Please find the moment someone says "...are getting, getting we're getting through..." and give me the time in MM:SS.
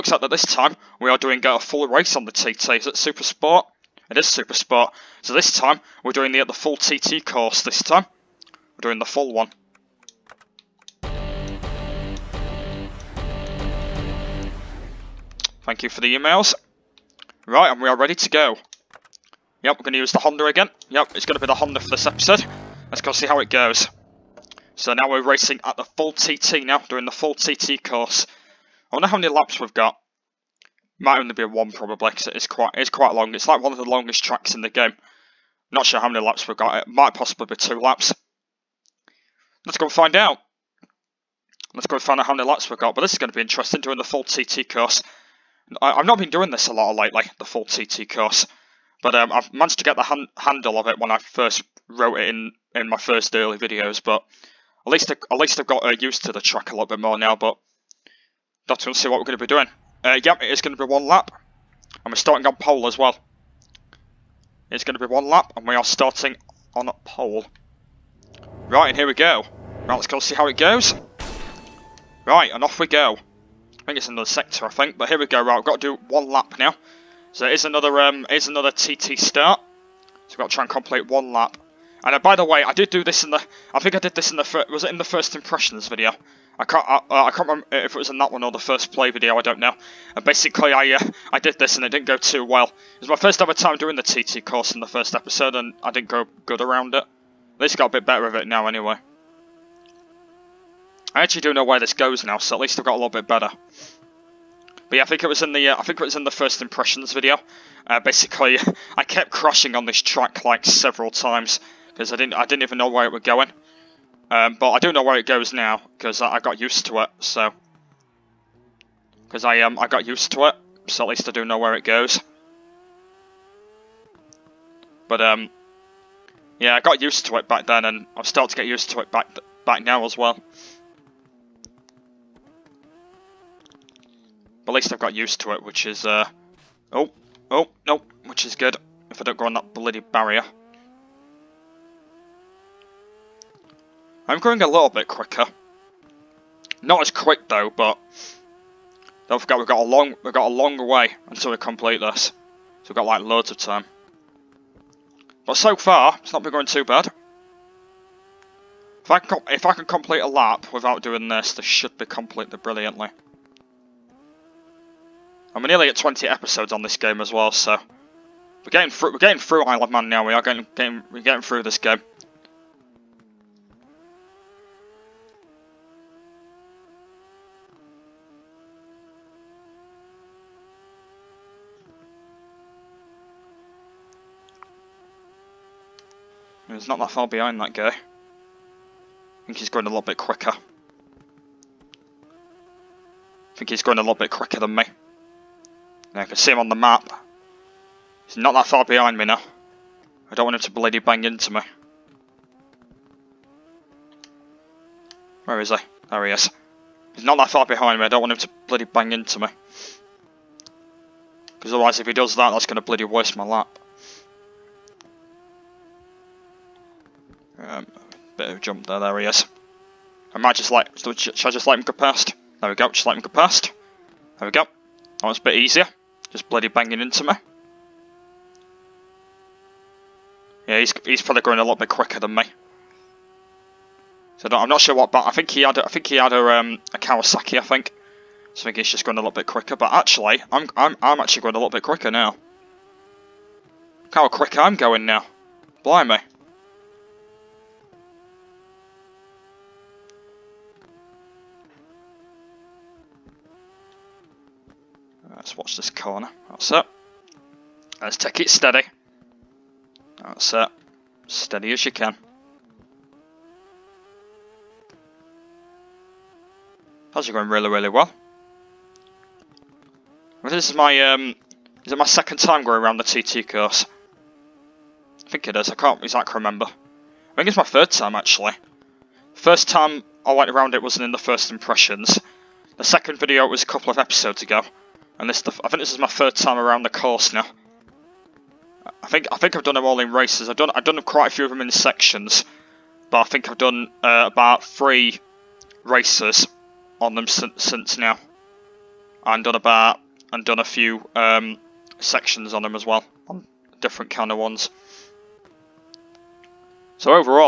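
02:50.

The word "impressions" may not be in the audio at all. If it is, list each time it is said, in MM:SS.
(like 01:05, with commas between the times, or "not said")
01:25, 01:46, 04:41.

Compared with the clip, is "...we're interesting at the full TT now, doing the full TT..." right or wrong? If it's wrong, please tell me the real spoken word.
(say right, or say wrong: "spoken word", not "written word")
wrong: "racing", not "interesting".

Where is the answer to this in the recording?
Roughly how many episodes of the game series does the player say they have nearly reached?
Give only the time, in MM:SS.
02:45.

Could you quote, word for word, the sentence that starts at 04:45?
And this, I think this is my third time around the course now.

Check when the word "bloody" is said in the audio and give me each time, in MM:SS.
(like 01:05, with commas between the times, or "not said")
02:19, 03:20, 03:28, 03:32, 03:46.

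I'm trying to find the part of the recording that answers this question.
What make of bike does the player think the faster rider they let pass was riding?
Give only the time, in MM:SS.
03:56.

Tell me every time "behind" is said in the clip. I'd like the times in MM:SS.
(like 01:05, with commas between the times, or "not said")
03:07, 03:18, 03:27.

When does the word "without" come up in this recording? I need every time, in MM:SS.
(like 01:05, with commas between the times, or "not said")
02:40.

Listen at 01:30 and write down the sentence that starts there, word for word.
And basically I uh, I did this and it didn't go too well.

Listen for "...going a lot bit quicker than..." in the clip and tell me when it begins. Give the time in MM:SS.
03:51.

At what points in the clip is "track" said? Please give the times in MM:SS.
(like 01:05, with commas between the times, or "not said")
00:34, 00:56, 01:50.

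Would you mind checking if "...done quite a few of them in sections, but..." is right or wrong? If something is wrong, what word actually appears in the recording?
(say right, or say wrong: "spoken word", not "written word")
right.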